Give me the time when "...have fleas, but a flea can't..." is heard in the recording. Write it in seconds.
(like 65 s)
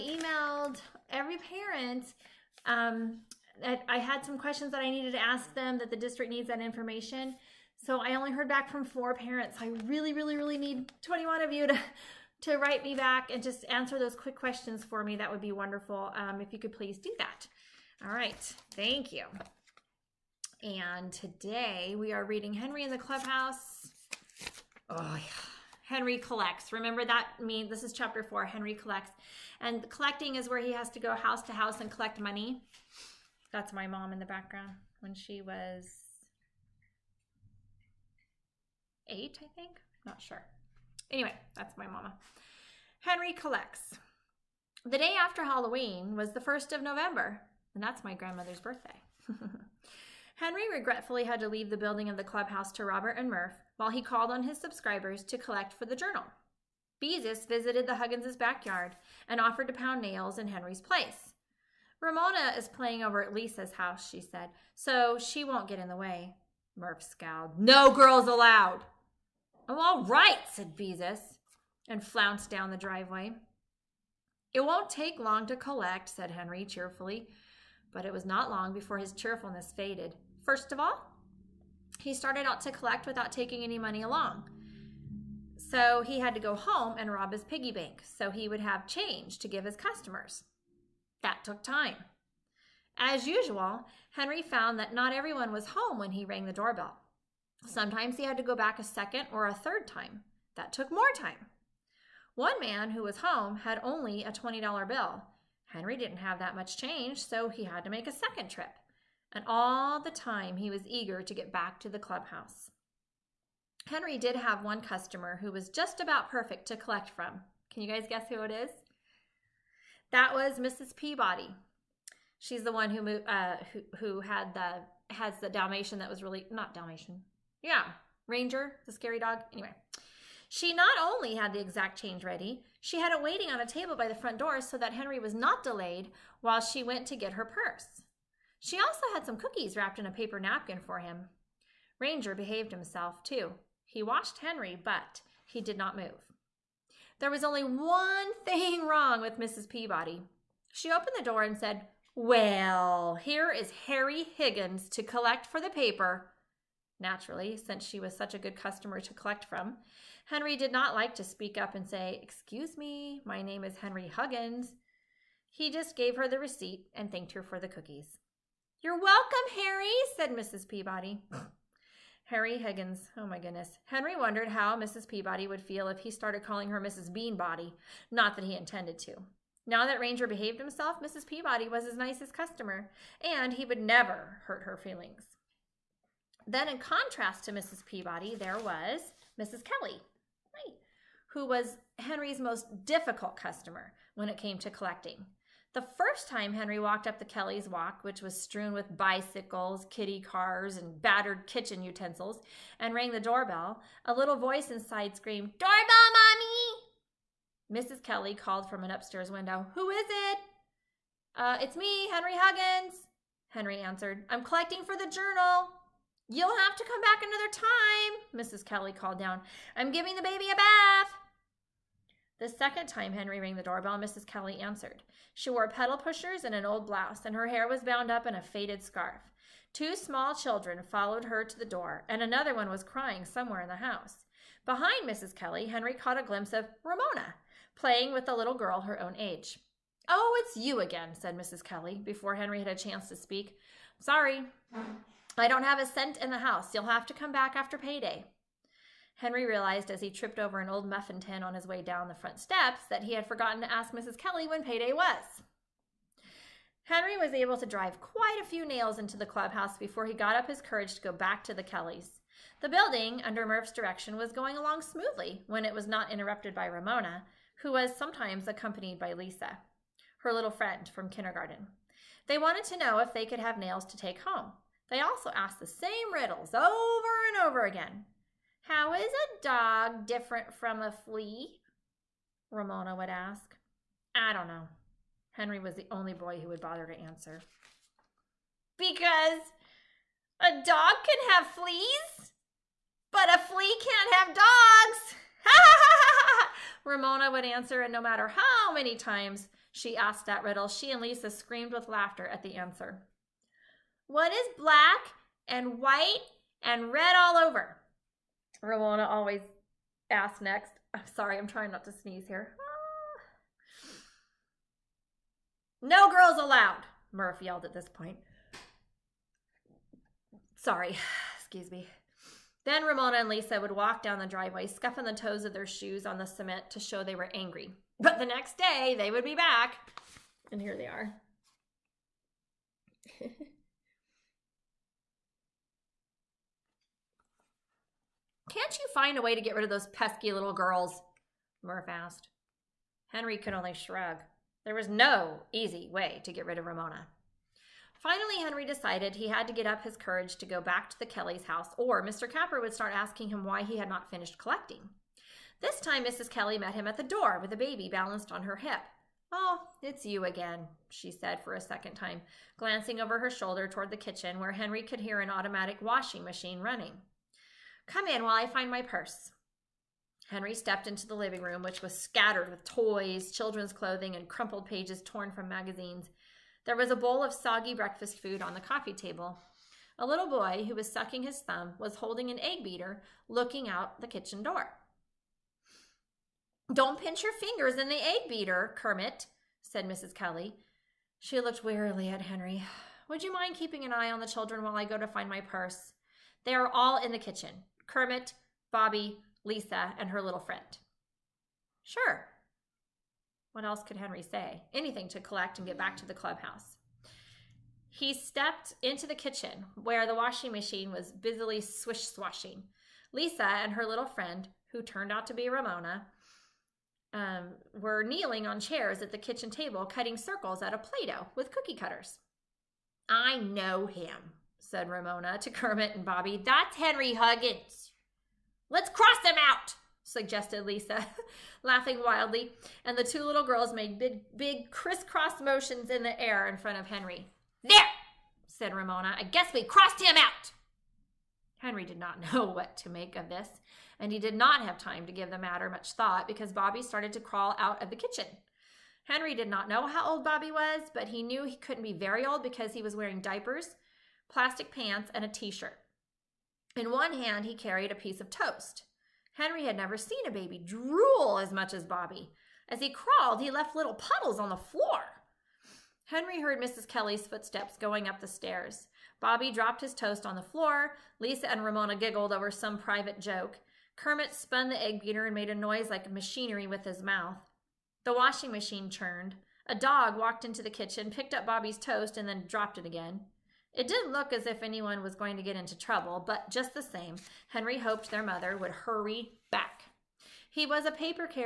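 291 s.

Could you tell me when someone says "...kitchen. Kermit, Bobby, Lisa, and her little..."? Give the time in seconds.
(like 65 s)
397 s.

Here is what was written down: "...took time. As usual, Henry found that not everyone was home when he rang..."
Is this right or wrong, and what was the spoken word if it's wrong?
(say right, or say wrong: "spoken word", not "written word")
right.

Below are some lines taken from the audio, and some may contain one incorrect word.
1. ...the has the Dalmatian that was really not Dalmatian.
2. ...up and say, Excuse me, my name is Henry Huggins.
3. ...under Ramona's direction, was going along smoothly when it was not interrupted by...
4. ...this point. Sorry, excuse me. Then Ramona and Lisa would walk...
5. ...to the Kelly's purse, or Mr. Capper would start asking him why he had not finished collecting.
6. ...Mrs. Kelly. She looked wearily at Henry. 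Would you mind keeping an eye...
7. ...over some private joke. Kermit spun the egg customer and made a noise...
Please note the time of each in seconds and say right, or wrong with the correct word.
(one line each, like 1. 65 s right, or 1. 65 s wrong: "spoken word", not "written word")
1. 124 s right
2. 161 s right
3. 263 s wrong: "Murph", not "Ramona"
4. 317 s right
5. 350 s wrong: "house", not "purse"
6. 389 s right
7. 472 s wrong: "beater", not "customer".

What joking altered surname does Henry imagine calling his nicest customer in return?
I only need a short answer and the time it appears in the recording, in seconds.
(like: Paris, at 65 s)
Mrs. Beanbody, at 176 s.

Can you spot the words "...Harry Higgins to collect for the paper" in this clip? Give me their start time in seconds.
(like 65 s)
153 s.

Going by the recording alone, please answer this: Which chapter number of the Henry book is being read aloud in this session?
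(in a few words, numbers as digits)
4.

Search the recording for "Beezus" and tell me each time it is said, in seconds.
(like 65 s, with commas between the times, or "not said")
57 s, 70 s.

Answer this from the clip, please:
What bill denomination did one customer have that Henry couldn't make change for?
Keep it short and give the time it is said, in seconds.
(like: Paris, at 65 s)
$20, at 104 s.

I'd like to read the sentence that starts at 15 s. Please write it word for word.
That would be wonderful um, if you could please do that.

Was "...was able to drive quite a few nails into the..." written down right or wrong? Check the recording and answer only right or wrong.
right.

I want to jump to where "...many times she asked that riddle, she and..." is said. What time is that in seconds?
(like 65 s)
298 s.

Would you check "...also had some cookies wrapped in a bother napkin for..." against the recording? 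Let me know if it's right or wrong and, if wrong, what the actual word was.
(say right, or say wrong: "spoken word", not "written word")
wrong: "paper", not "bother".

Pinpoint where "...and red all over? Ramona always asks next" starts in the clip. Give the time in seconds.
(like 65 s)
306 s.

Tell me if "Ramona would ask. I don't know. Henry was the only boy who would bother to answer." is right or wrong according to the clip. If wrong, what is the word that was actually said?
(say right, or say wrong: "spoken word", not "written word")
right.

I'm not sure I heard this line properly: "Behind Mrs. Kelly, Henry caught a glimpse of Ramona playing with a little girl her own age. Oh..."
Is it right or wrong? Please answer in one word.
right.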